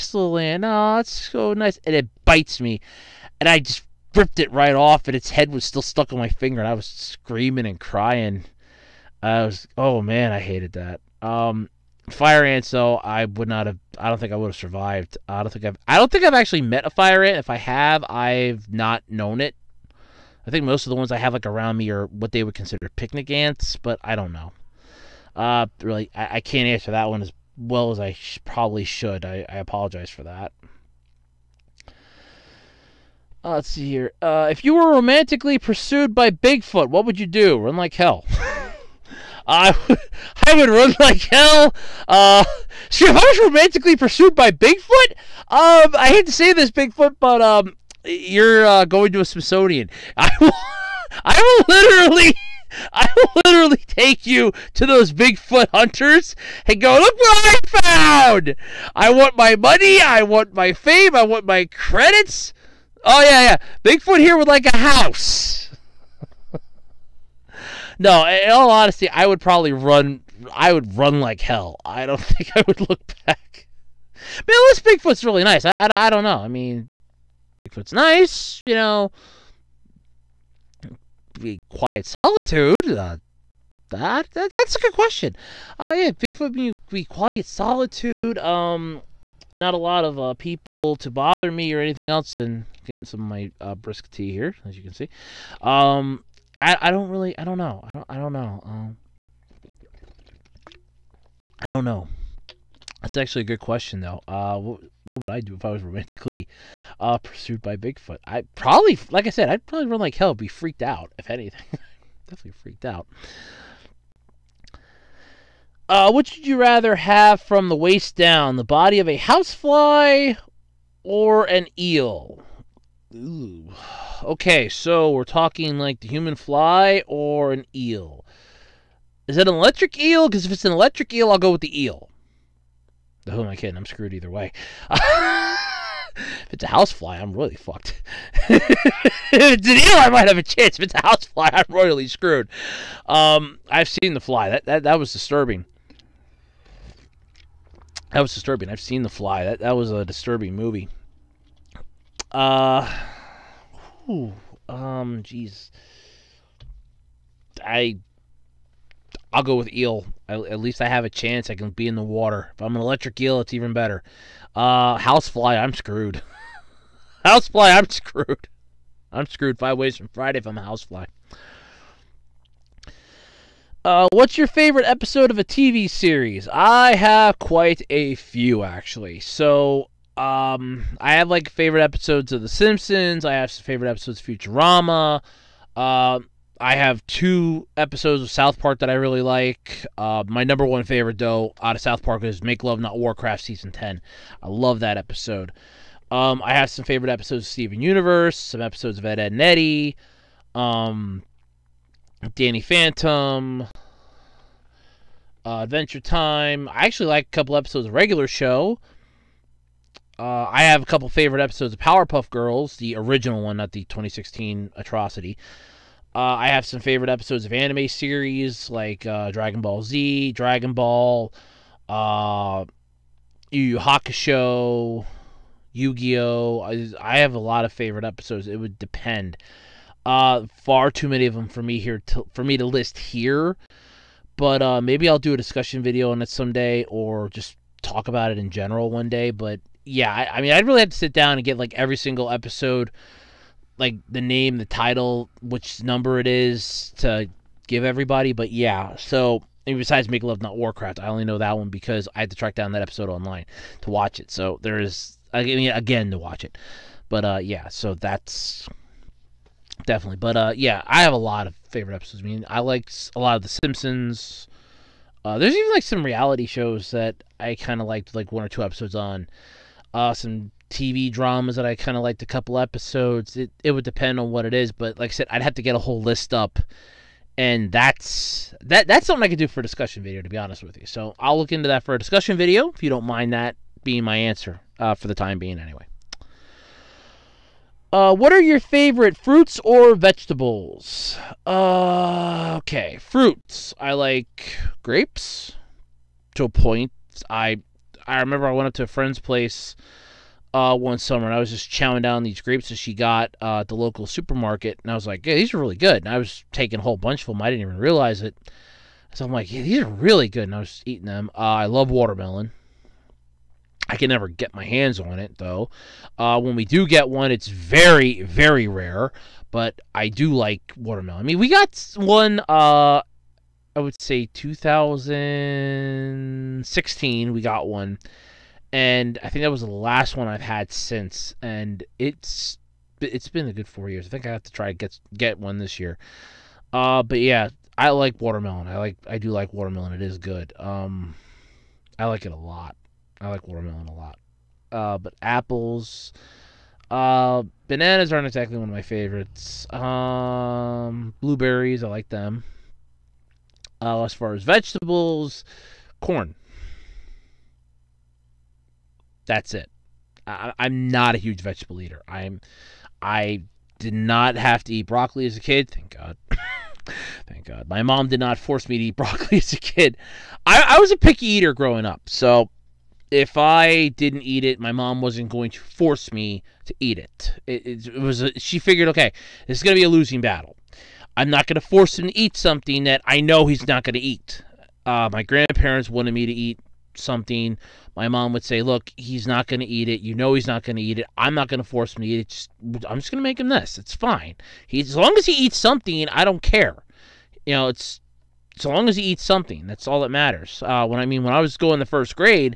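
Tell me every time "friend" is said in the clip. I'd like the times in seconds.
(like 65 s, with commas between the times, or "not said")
298 s.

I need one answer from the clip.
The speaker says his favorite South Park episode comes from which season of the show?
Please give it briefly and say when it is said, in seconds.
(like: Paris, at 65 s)
Season 10, at 193 s.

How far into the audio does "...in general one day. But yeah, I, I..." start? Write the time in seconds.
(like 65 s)
238 s.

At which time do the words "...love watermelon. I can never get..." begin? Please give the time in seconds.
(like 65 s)
311 s.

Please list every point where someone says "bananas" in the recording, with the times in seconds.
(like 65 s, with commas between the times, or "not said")
347 s.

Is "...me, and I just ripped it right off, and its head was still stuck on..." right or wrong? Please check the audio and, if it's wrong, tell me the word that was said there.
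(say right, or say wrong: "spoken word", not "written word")
right.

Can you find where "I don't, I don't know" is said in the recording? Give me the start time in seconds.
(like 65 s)
97 s.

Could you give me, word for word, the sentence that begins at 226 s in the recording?
I, I have a lot of favorite episodes.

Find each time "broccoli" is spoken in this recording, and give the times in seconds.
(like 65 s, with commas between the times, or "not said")
364 s, 368 s.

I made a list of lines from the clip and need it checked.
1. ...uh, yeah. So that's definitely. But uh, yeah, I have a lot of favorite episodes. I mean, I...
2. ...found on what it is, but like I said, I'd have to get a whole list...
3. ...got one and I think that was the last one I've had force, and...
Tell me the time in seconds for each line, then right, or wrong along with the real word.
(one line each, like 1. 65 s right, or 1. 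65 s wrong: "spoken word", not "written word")
1. 257 s right
2. 273 s wrong: "depend", not "found"
3. 327 s wrong: "since", not "force".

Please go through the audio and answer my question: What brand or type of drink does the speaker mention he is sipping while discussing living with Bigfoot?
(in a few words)
brisk tea.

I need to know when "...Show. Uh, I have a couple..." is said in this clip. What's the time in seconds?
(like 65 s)
208 s.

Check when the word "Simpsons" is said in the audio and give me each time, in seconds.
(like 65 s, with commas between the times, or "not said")
182 s, 263 s.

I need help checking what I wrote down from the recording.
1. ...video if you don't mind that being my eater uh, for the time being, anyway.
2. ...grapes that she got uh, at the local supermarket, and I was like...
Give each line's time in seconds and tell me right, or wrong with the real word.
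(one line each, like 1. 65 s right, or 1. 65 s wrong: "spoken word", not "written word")
1. 282 s wrong: "answer", not "eater"
2. 302 s right.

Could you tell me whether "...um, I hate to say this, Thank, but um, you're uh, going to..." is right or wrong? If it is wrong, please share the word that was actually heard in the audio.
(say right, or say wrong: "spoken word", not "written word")
wrong: "Bigfoot", not "Thank".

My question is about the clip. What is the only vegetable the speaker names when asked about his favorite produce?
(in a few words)
corn.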